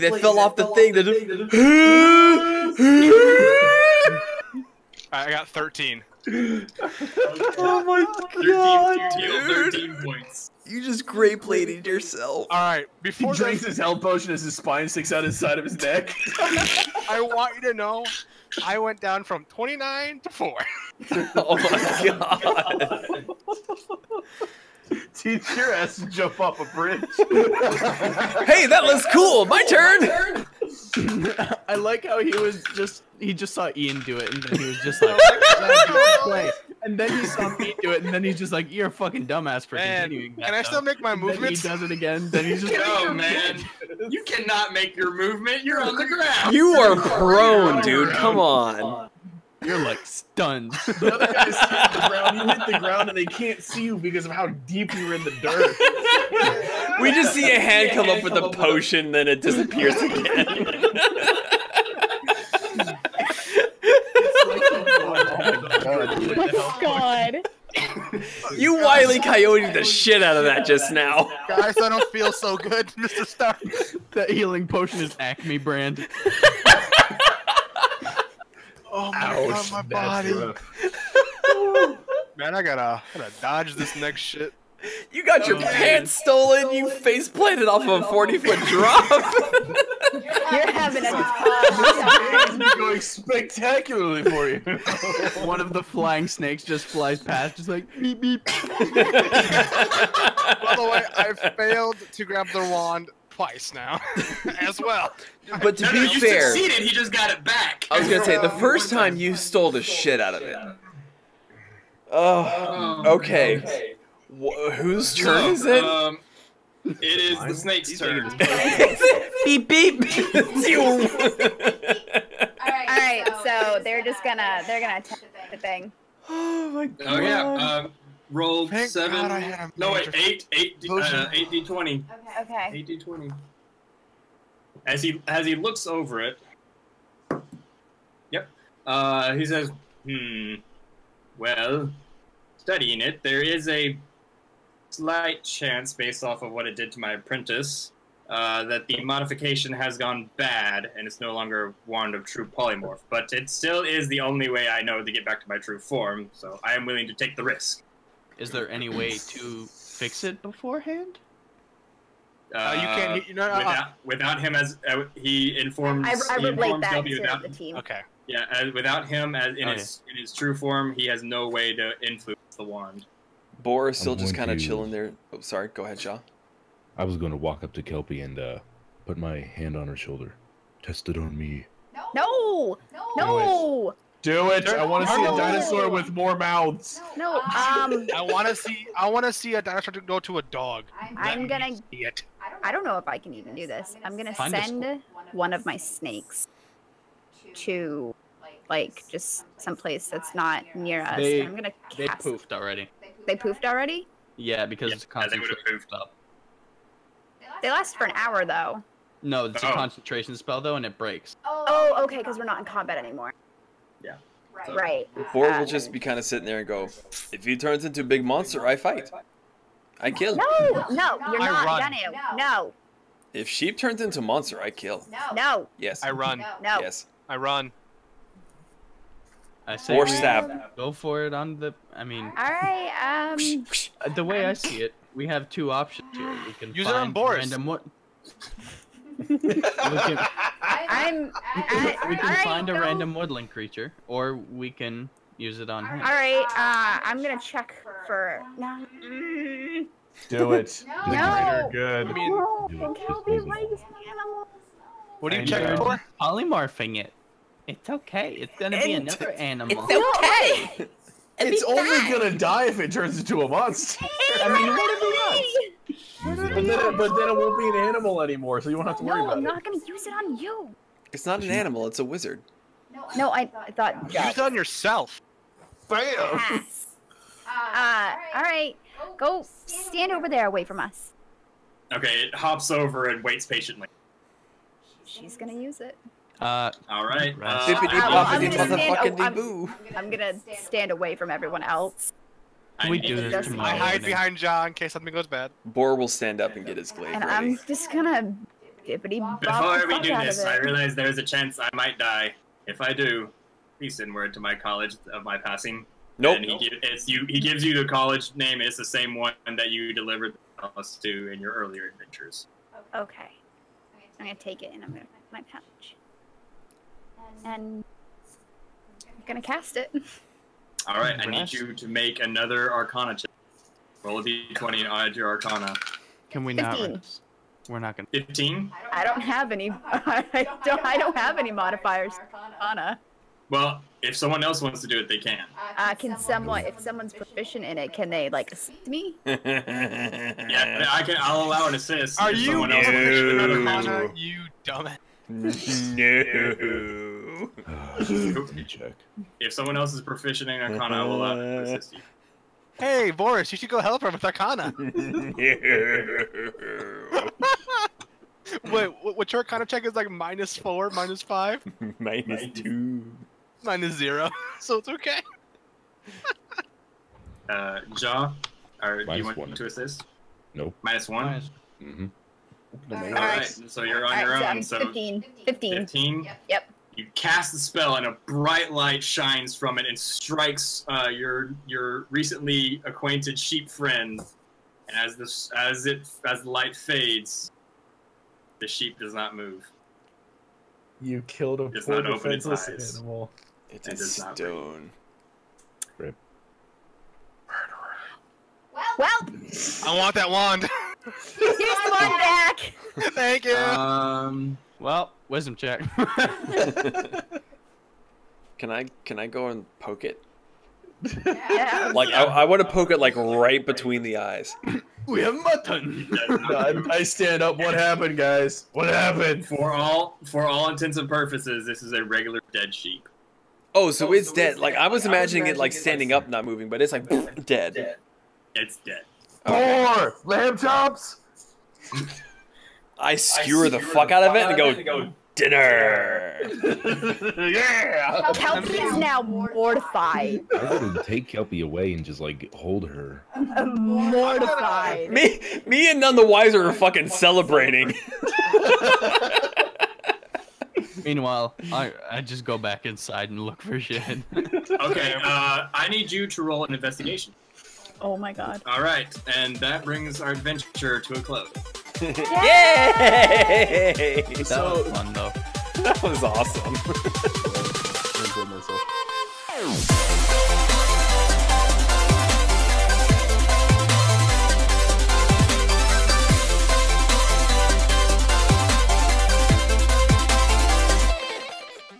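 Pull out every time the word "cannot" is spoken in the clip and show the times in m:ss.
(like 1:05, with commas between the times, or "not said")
0:44.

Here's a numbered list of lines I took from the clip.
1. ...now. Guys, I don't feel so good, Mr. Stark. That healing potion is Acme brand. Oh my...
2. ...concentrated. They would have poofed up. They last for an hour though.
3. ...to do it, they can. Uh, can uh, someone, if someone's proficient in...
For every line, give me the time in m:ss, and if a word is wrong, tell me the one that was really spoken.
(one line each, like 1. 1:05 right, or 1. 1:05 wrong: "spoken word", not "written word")
1. 1:10 right
2. 3:25 right
3. 5:34 right.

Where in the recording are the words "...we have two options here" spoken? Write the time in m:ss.
3:55.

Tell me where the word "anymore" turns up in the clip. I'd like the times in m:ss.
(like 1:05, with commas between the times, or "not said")
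3:32, 4:28.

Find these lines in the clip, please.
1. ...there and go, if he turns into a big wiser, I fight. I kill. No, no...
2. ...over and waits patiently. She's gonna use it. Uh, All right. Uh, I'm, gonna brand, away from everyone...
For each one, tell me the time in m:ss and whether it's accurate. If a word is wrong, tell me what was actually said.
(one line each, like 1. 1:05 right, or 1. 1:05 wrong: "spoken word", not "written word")
1. 3:36 wrong: "monster", not "wiser"
2. 4:42 wrong: "stand", not "brand".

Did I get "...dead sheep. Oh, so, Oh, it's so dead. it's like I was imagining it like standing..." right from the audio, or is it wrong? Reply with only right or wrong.
wrong.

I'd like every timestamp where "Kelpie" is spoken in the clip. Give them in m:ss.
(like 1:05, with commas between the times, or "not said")
2:57, 7:21.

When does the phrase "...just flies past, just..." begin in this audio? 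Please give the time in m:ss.
1:36.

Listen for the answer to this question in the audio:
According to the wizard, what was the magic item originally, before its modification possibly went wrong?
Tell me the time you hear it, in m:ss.
2:31.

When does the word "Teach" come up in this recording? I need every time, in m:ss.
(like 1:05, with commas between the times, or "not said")
0:25.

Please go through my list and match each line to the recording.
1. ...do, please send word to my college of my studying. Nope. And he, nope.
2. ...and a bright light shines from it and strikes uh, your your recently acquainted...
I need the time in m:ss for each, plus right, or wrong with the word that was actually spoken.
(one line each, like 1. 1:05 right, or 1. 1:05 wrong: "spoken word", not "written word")
1. 5:02 wrong: "passing", not "studying"
2. 6:17 right.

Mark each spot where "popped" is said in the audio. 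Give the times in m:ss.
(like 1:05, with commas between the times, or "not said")
not said.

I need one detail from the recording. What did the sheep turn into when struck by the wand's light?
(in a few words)
stone.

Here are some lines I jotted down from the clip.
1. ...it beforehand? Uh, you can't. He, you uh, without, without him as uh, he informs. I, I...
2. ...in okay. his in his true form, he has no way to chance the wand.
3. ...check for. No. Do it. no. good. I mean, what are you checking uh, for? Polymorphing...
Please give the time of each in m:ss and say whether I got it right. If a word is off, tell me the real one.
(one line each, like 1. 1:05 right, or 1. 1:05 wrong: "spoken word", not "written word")
1. 2:40 right
2. 2:49 wrong: "influence", not "chance"
3. 4:07 right.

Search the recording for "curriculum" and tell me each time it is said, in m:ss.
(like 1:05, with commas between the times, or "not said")
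not said.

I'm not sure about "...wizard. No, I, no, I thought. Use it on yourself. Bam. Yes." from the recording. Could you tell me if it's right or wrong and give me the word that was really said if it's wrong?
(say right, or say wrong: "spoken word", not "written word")
right.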